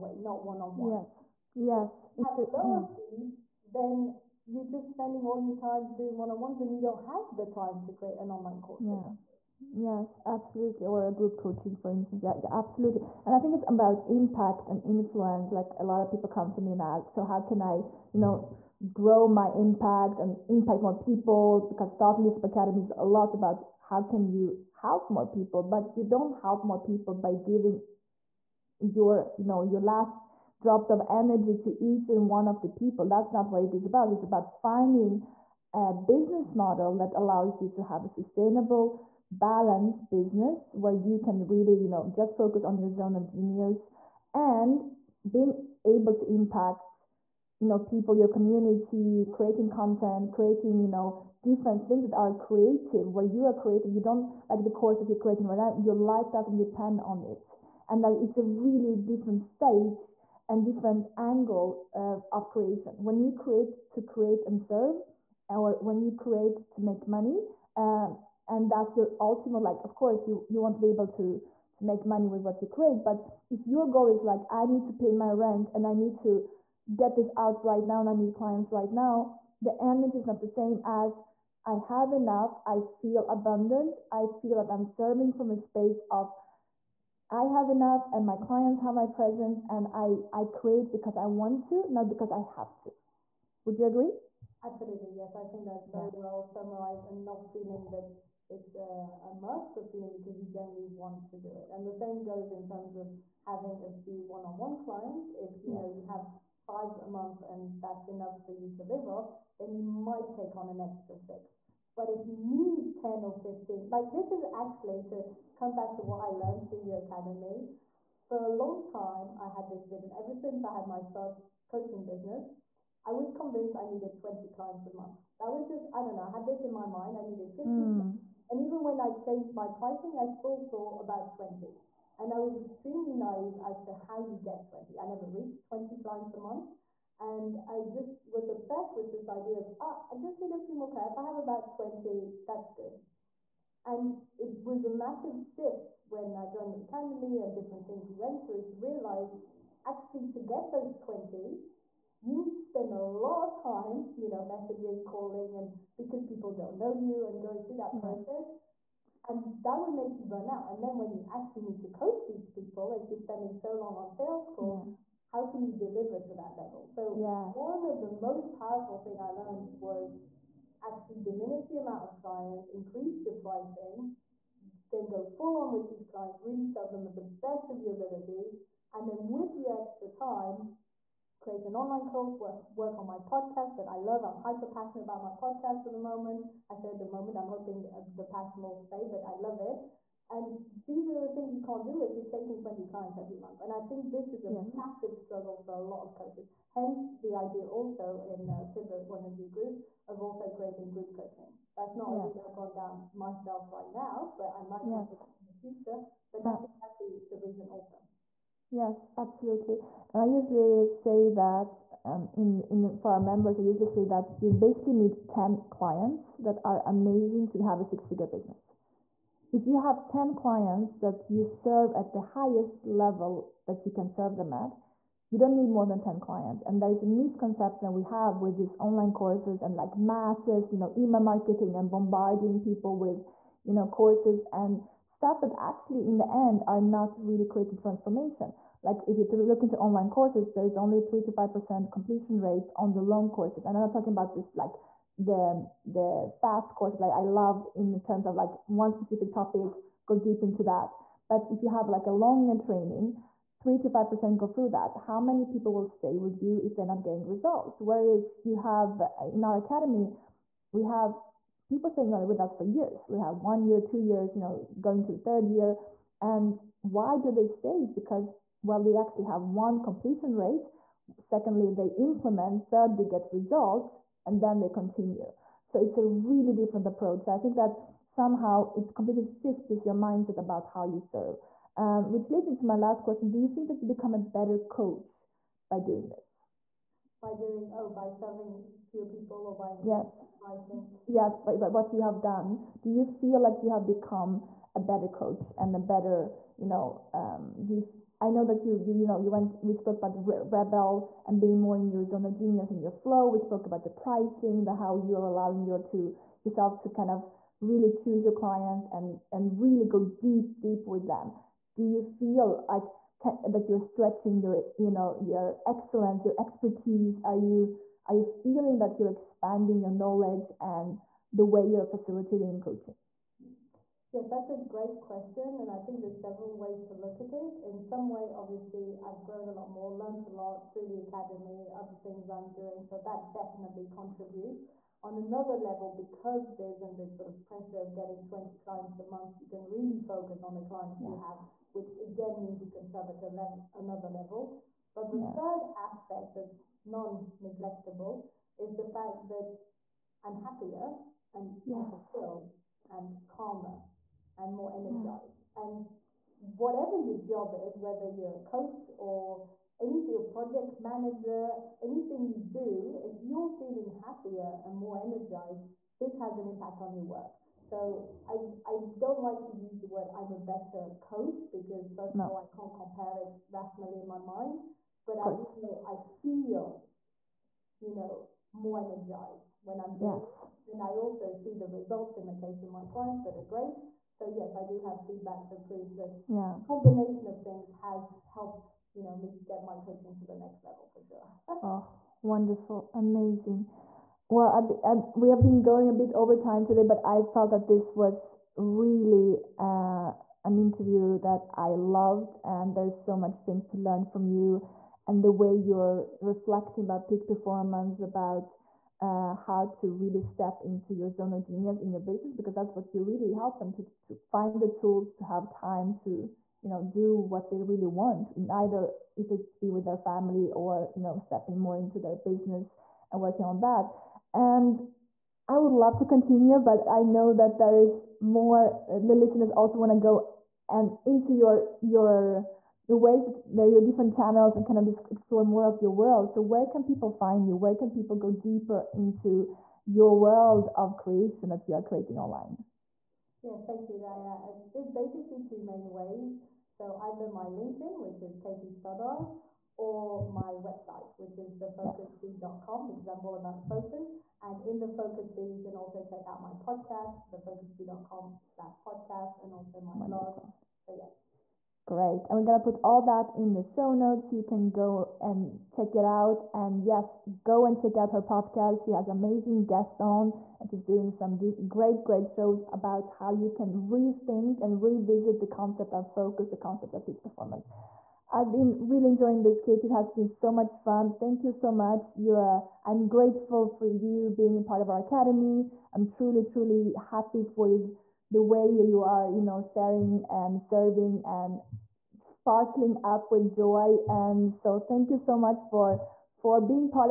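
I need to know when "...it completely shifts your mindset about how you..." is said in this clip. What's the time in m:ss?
4:38.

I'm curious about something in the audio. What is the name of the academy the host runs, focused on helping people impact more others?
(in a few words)
Thought Leadership Academy.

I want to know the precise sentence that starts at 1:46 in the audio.
know you have five a month and that's enough for you to live off, then you might take on an extra six.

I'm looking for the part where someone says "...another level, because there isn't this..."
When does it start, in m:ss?
5:35.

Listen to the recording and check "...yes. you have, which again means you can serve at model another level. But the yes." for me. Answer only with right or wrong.
wrong.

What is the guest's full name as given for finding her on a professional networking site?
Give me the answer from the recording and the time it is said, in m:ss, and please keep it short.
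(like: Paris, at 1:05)
Katie Stoddart, at 7:28.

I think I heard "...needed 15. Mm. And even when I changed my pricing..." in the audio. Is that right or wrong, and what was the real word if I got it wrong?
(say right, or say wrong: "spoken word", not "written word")
right.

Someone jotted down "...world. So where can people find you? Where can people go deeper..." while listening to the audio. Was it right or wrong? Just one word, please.
right.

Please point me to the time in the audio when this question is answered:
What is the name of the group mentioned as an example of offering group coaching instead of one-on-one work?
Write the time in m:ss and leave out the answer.
3:18.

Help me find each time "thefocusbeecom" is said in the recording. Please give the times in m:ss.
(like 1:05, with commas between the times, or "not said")
7:31, 7:37.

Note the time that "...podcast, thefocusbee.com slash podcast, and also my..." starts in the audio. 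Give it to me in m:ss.
7:36.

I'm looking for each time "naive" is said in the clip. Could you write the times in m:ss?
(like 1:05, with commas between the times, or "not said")
2:13.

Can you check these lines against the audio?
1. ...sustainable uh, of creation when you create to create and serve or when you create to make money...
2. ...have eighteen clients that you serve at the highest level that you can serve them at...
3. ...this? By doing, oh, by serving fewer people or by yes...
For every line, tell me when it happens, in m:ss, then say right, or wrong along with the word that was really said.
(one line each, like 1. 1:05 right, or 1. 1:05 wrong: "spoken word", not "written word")
1. 1:01 wrong: "angle", not "sustainable"
2. 3:39 wrong: "ten", not "eighteen"
3. 4:46 right.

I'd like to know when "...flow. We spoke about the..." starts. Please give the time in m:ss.
5:02.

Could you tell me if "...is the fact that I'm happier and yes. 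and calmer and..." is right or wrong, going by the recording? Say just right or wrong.
right.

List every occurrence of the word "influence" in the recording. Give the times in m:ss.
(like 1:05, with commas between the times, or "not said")
0:14.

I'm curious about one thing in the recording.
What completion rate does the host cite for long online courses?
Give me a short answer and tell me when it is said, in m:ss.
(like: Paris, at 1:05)
3 to 5%, at 4:00.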